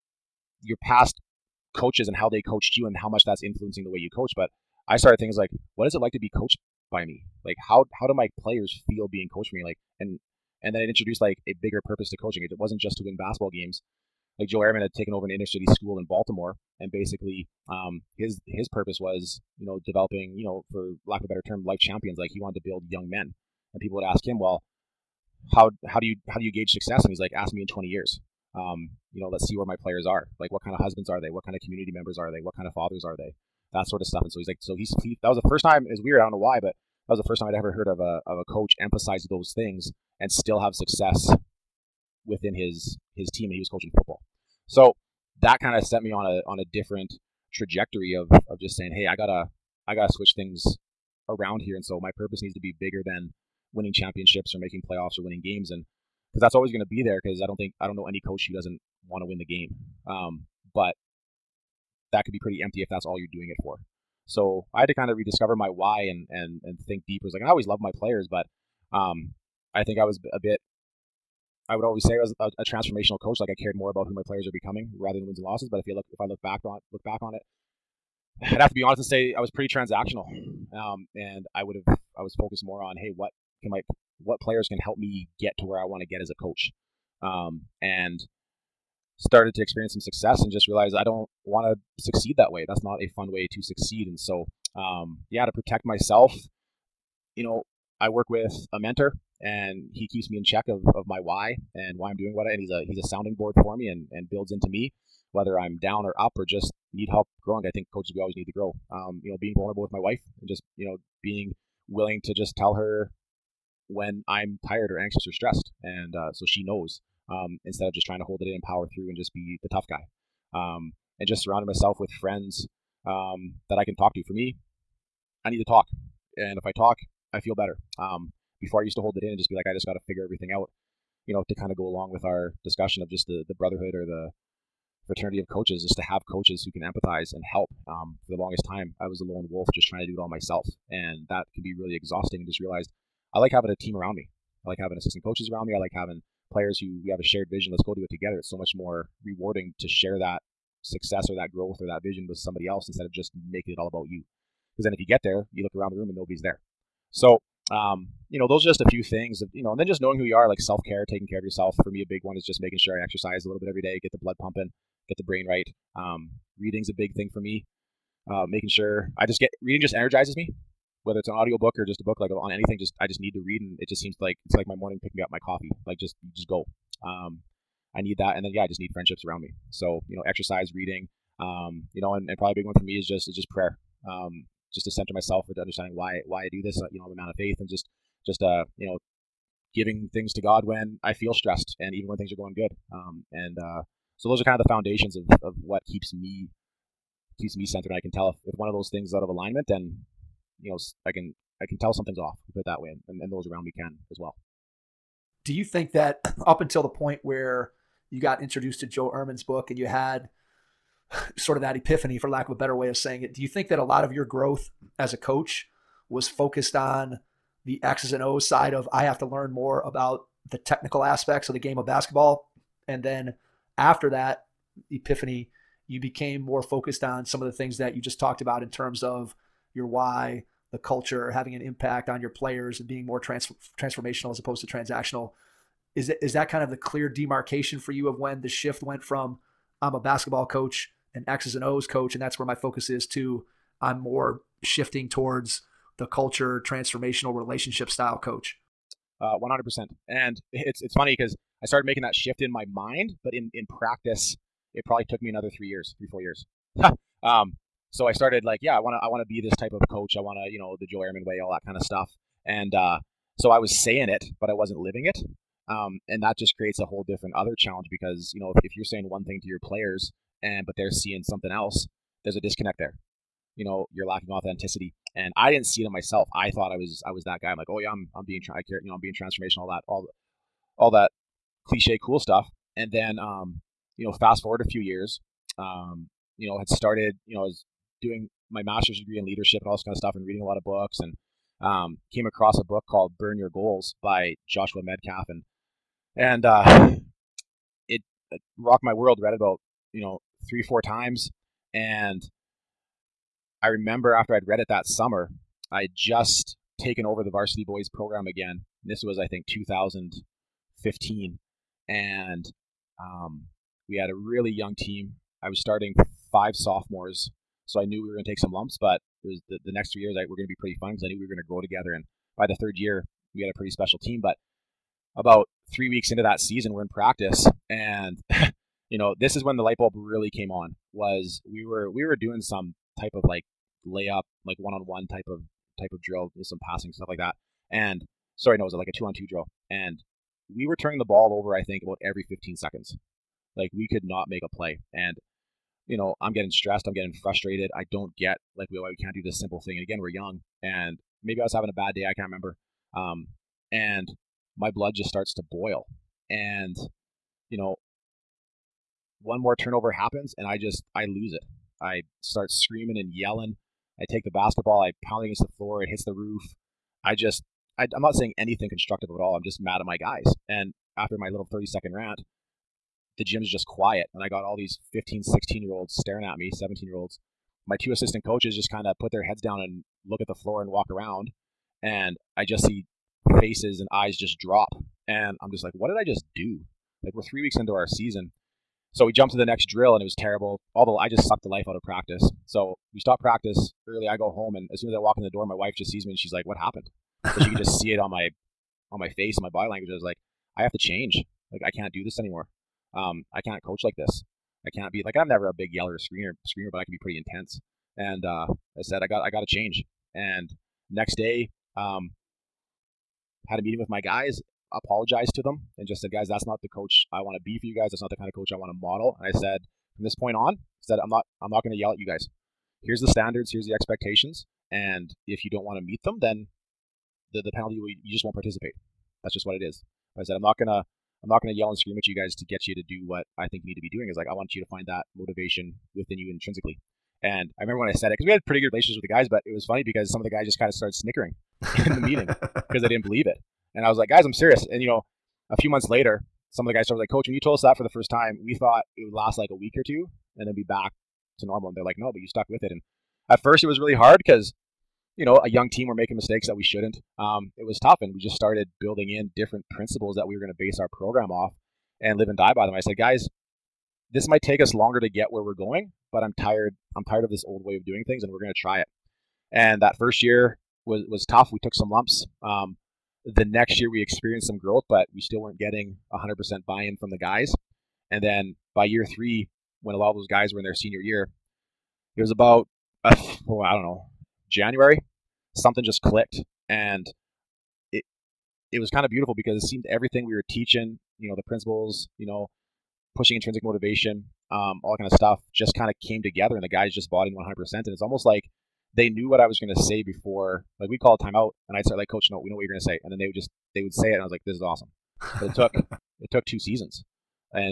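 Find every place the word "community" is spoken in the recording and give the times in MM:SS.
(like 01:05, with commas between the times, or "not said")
00:31.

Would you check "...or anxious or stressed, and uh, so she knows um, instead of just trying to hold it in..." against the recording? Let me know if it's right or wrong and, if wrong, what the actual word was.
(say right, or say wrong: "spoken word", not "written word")
right.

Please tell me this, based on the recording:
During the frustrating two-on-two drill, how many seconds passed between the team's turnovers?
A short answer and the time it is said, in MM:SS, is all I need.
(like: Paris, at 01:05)
15 seconds, at 05:42.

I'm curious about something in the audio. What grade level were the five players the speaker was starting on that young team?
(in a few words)
sophomores.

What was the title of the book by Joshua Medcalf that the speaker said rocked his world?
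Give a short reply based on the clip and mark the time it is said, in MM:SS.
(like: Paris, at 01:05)
Burn Your Goals, at 04:53.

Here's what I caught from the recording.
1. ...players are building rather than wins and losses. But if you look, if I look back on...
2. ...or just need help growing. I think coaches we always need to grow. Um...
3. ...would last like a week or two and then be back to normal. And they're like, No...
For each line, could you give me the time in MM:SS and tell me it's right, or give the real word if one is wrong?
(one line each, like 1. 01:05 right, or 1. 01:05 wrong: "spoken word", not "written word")
1. 01:14 wrong: "becoming", not "building"
2. 01:46 right
3. 07:29 right.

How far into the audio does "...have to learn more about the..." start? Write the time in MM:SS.
03:39.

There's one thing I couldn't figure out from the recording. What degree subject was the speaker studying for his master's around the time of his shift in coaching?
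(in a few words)
leadership.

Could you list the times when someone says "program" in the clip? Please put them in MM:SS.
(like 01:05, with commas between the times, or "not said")
05:07, 07:40.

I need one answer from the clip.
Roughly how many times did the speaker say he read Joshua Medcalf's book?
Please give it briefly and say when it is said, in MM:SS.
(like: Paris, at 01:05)
3 or 4 times, at 05:00.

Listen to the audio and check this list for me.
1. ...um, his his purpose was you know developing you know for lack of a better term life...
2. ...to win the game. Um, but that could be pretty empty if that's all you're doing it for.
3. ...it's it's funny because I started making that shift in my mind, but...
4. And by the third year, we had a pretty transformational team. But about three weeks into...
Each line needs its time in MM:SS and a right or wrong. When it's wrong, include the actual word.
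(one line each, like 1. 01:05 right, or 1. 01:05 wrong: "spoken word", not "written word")
1. 00:17 right
2. 00:59 right
3. 04:10 right
4. 05:21 wrong: "special", not "transformational".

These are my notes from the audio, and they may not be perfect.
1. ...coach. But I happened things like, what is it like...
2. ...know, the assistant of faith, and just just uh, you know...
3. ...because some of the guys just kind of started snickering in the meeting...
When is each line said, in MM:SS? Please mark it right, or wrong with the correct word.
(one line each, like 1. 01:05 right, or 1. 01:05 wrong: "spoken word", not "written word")
1. 00:04 wrong: "started", not "happened"
2. 03:06 wrong: "amount", not "assistant"
3. 07:19 right.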